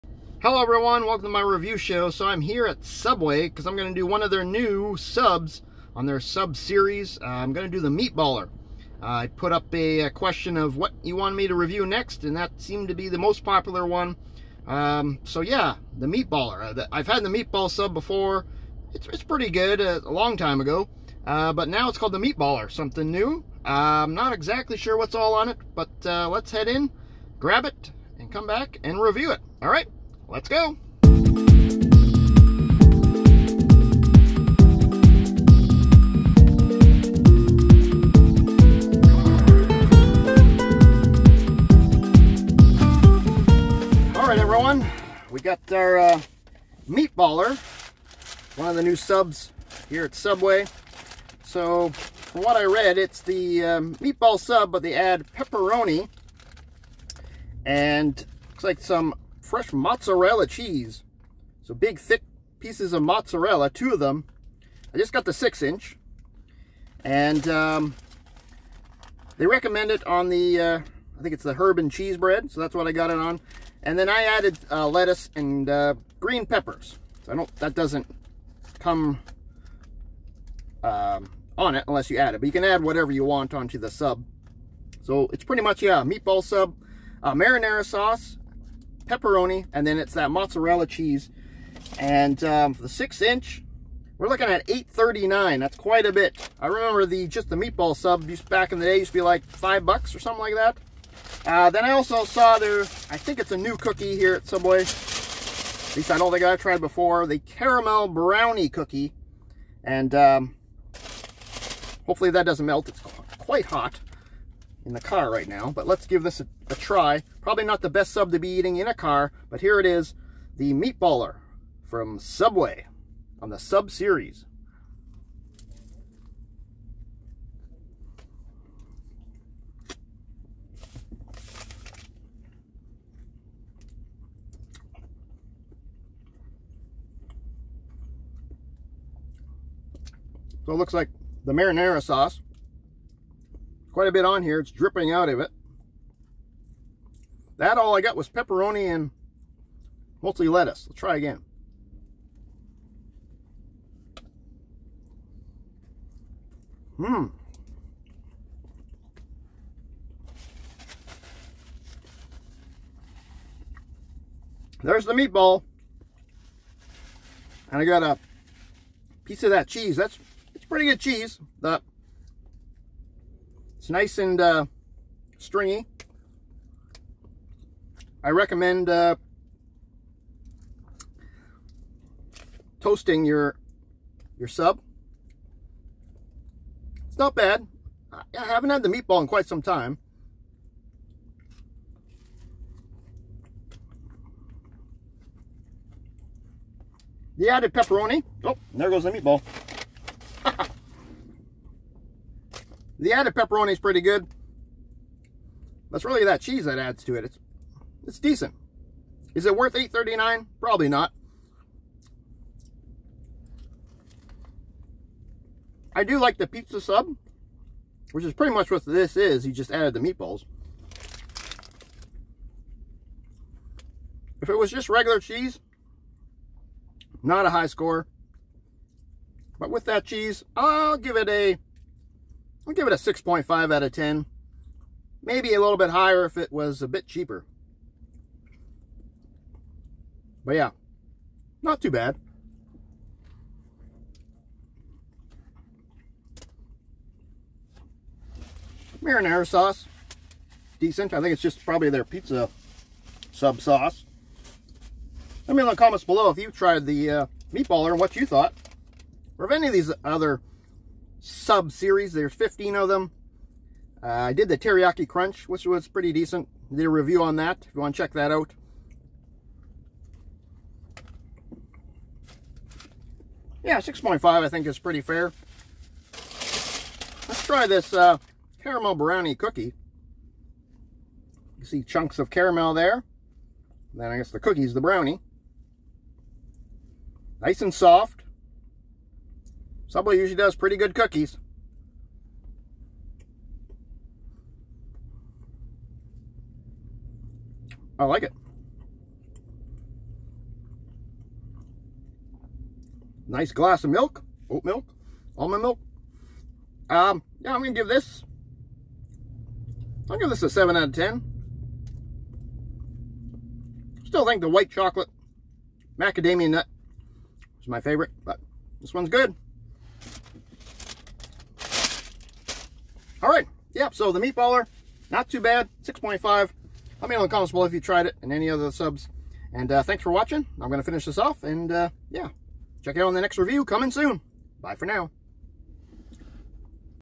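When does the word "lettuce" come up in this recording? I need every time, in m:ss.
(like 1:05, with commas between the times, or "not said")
1:14, 2:30.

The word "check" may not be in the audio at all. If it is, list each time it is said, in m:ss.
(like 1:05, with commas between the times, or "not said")
4:28, 5:32.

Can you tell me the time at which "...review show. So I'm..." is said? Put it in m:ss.
0:01.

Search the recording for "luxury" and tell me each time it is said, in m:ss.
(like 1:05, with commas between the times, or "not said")
not said.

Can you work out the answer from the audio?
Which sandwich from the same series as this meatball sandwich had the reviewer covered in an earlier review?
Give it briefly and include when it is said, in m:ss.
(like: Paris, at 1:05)
Teriyaki Crunch, at 4:24.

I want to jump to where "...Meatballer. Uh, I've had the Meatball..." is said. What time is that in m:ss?
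0:16.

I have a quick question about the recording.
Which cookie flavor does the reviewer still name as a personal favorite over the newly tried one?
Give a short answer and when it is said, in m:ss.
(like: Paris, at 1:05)
White chocolate macadamia nut, at 5:14.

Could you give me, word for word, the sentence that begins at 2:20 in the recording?
So it looks like the marinara sauce quite a bit on here.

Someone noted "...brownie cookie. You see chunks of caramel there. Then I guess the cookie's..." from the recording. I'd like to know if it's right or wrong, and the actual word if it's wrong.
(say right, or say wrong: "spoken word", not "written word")
right.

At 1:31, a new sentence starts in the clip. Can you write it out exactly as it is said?
And um, the six inch, we're looking at 8.39.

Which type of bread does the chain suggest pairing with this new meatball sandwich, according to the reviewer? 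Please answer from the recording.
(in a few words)
Herb and cheese.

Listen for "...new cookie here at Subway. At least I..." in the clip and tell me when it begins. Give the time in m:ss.
1:43.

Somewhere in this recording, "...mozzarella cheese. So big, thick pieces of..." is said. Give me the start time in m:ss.
0:59.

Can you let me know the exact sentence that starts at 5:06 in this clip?
Um, yeah, I'm gonna give this, I'll give this a seven out of 10.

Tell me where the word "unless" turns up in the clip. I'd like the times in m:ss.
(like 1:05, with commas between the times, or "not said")
1:21.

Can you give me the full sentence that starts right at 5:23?
All right, yeah, so the meatballer, not too bad, 6.5.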